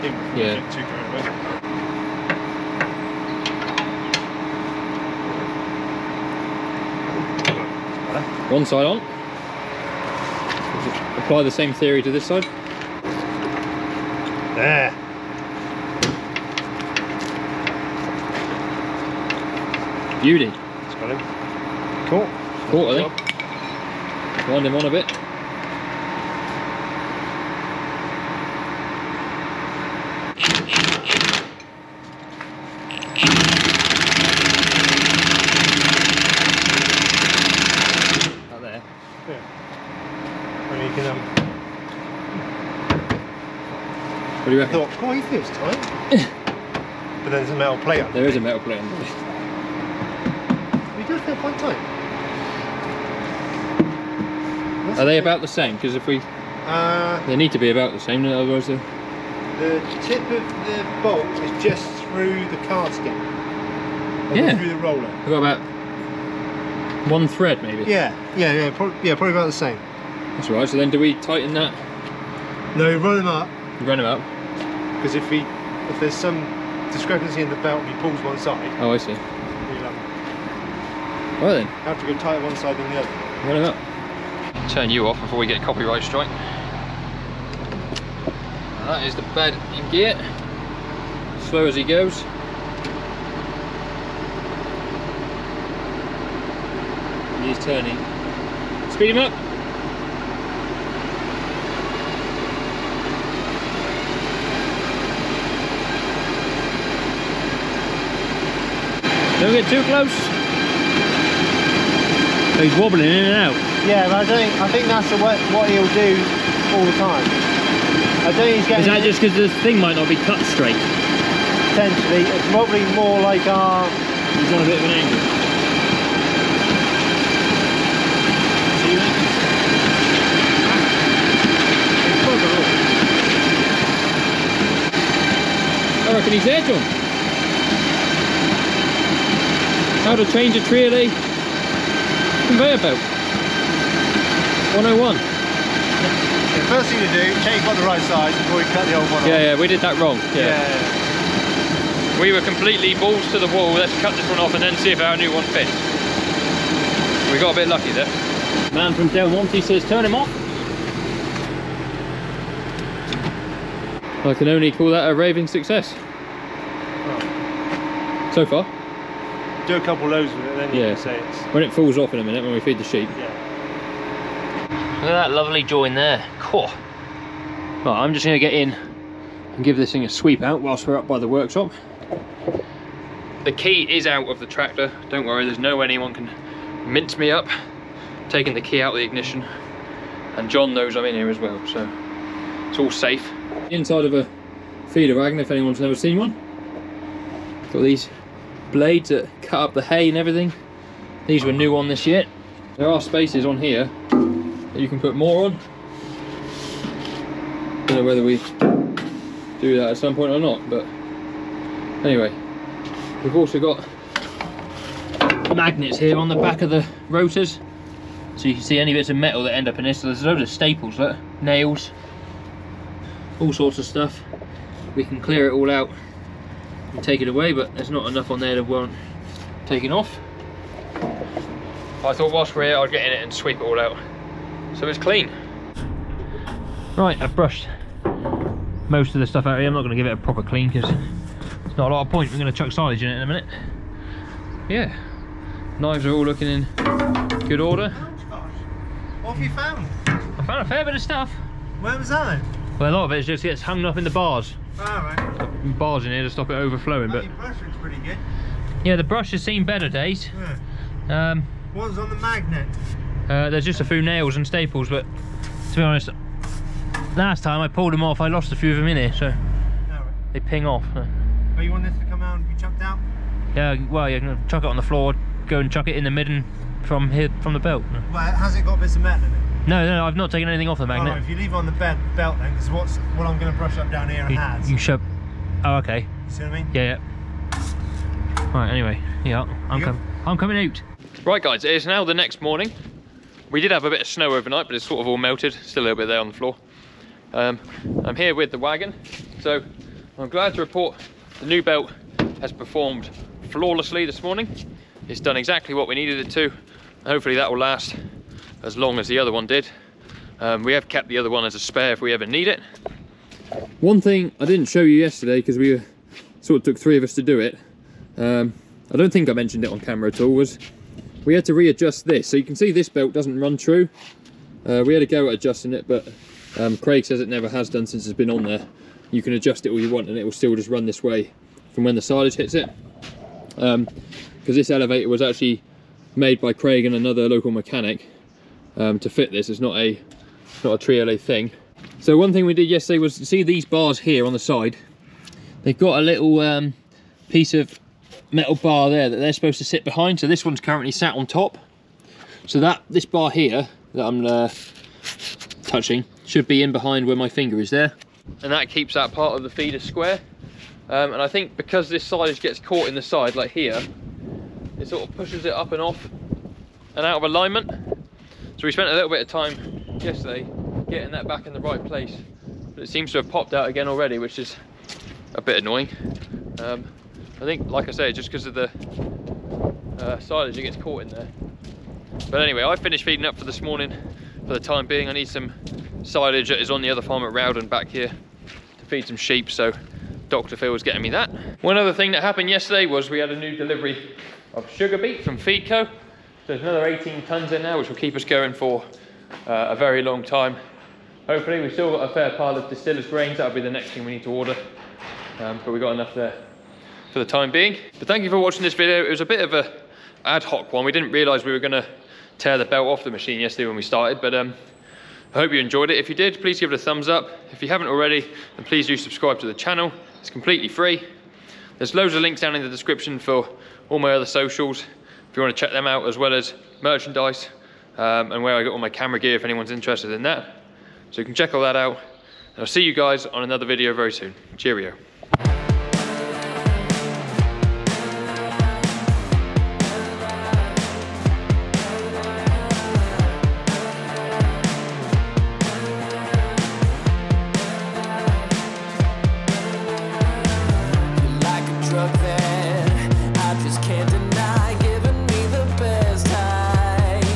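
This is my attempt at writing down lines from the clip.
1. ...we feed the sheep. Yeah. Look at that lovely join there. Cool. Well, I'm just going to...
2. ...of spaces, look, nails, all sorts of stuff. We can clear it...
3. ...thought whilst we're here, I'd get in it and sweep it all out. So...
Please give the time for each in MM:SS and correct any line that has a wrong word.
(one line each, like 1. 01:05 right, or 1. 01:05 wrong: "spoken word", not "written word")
1. 02:52 right
2. 03:40 wrong: "staples", not "spaces"
3. 03:52 right.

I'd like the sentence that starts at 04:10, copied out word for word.
I found a fair bit of stuff.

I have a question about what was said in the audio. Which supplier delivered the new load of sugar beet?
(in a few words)
Feedco.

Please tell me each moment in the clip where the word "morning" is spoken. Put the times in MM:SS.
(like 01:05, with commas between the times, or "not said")
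04:52, 05:04, 06:23.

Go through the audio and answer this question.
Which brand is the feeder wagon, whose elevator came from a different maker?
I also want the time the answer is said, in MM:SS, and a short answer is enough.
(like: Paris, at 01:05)
Trioliet, at 05:40.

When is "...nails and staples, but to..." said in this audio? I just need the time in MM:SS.
04:24.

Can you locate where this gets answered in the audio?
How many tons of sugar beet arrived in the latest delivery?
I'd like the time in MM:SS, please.
06:36.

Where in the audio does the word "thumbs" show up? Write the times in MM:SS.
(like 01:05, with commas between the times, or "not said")
06:56.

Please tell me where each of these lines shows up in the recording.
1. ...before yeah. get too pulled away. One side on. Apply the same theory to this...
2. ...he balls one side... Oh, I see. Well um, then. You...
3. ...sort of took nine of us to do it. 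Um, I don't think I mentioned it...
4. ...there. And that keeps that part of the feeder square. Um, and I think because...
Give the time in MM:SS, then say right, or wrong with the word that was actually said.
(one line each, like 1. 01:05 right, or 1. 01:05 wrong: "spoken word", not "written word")
1. 00:00 wrong: "carried", not "pulled"
2. 01:17 wrong: "pulls", not "balls"
3. 05:16 wrong: "three", not "nine"
4. 05:57 right.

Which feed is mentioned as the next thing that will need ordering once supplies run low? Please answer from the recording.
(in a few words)
distillers grains.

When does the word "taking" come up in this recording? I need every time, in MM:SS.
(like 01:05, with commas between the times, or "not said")
03:08, 03:49.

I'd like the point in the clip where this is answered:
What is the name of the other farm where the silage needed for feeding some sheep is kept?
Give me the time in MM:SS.
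06:27.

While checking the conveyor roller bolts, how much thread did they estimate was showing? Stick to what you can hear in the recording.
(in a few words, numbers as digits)
one thread.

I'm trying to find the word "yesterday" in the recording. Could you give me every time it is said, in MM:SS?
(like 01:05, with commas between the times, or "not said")
05:14, 05:42, 06:10, 06:32, 06:53.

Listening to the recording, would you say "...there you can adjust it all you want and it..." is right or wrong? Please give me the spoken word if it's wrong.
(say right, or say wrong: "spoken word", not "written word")
right.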